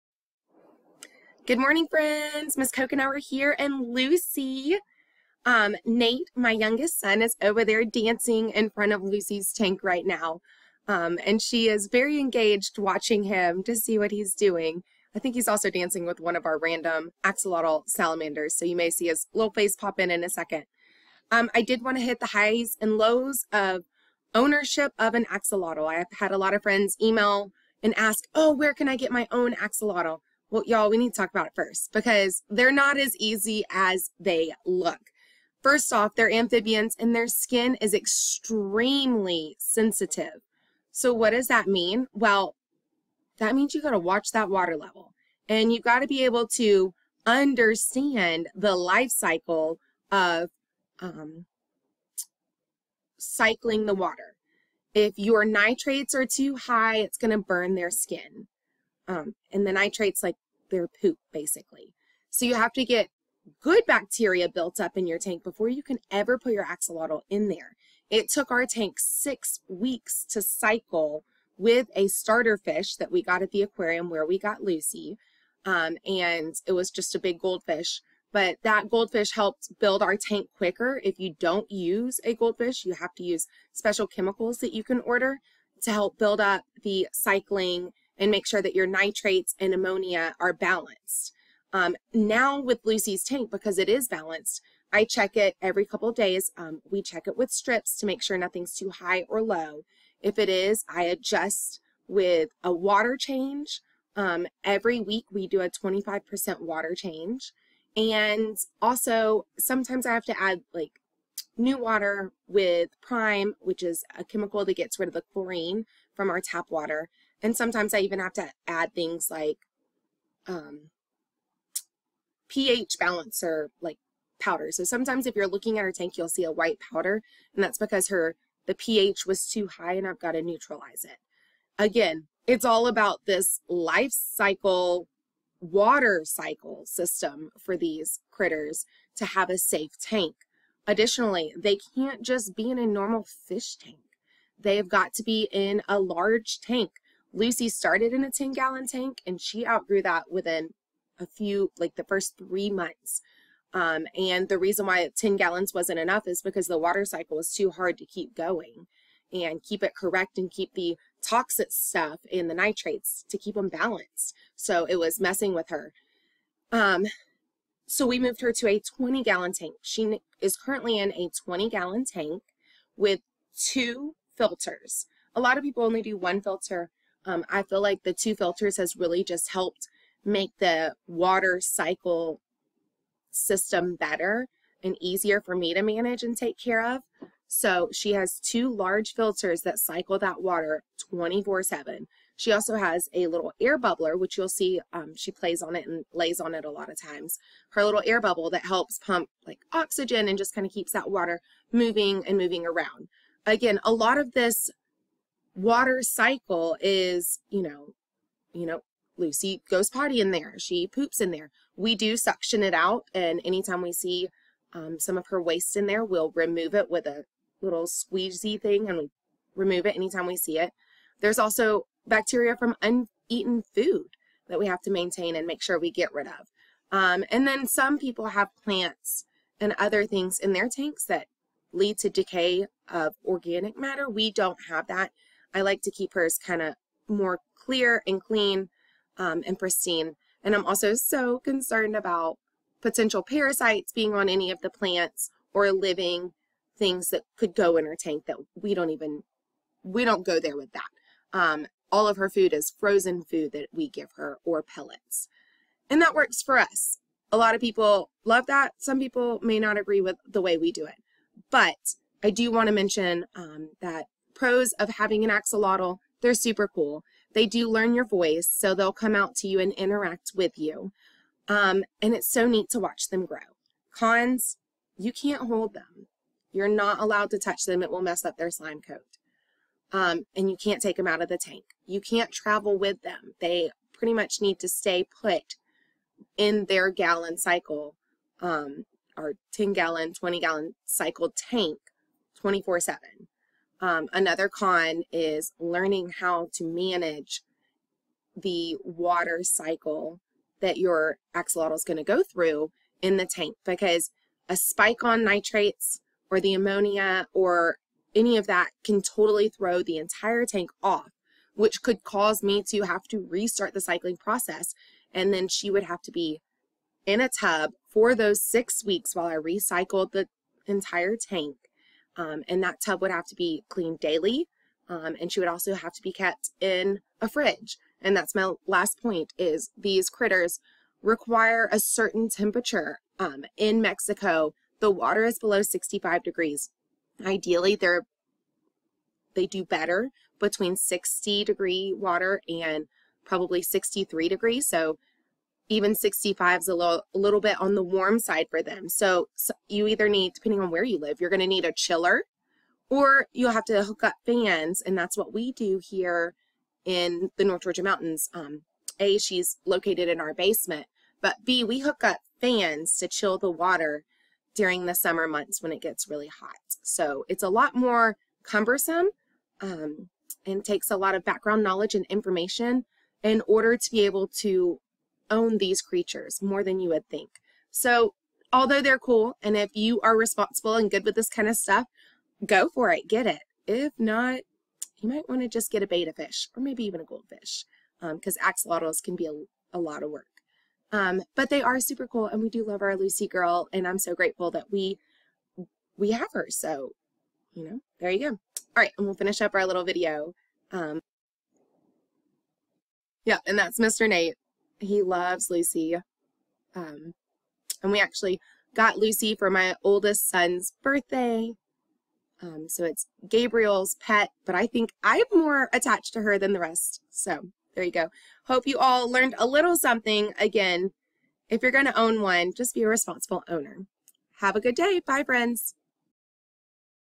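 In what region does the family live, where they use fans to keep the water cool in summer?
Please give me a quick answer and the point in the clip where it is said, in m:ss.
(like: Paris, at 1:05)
North Georgia Mountains, at 5:57.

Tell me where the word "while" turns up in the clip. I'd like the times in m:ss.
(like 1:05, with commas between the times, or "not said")
5:19.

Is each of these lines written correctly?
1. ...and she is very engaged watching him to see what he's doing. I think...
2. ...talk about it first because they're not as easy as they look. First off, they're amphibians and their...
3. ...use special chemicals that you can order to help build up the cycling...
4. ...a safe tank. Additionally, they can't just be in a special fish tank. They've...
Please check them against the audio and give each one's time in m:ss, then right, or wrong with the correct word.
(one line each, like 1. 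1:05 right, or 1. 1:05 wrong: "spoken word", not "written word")
1. 0:11 right
2. 0:31 right
3. 1:23 right
4. 2:19 wrong: "normal", not "special".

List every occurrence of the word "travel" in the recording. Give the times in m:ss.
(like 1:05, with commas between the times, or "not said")
4:42.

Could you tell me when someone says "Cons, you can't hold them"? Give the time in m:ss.
4:33.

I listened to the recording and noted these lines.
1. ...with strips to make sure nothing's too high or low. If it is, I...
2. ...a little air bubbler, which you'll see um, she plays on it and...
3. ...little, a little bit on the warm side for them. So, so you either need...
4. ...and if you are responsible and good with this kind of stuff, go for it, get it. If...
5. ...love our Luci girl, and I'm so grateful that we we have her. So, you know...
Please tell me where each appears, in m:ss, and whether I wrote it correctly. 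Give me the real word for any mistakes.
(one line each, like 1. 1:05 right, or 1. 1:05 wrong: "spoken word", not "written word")
1. 1:37 right
2. 3:13 right
3. 5:46 right
4. 6:19 right
5. 6:32 right.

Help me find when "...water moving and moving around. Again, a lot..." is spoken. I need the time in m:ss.
3:21.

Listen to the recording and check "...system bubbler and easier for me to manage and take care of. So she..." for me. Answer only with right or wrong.
wrong.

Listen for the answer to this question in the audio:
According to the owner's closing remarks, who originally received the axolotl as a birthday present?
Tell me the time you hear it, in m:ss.
6:53.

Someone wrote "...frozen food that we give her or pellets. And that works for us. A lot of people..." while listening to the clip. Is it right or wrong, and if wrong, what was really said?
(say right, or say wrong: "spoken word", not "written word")
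right.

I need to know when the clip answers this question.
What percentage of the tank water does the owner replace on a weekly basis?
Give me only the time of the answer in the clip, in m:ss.
1:45.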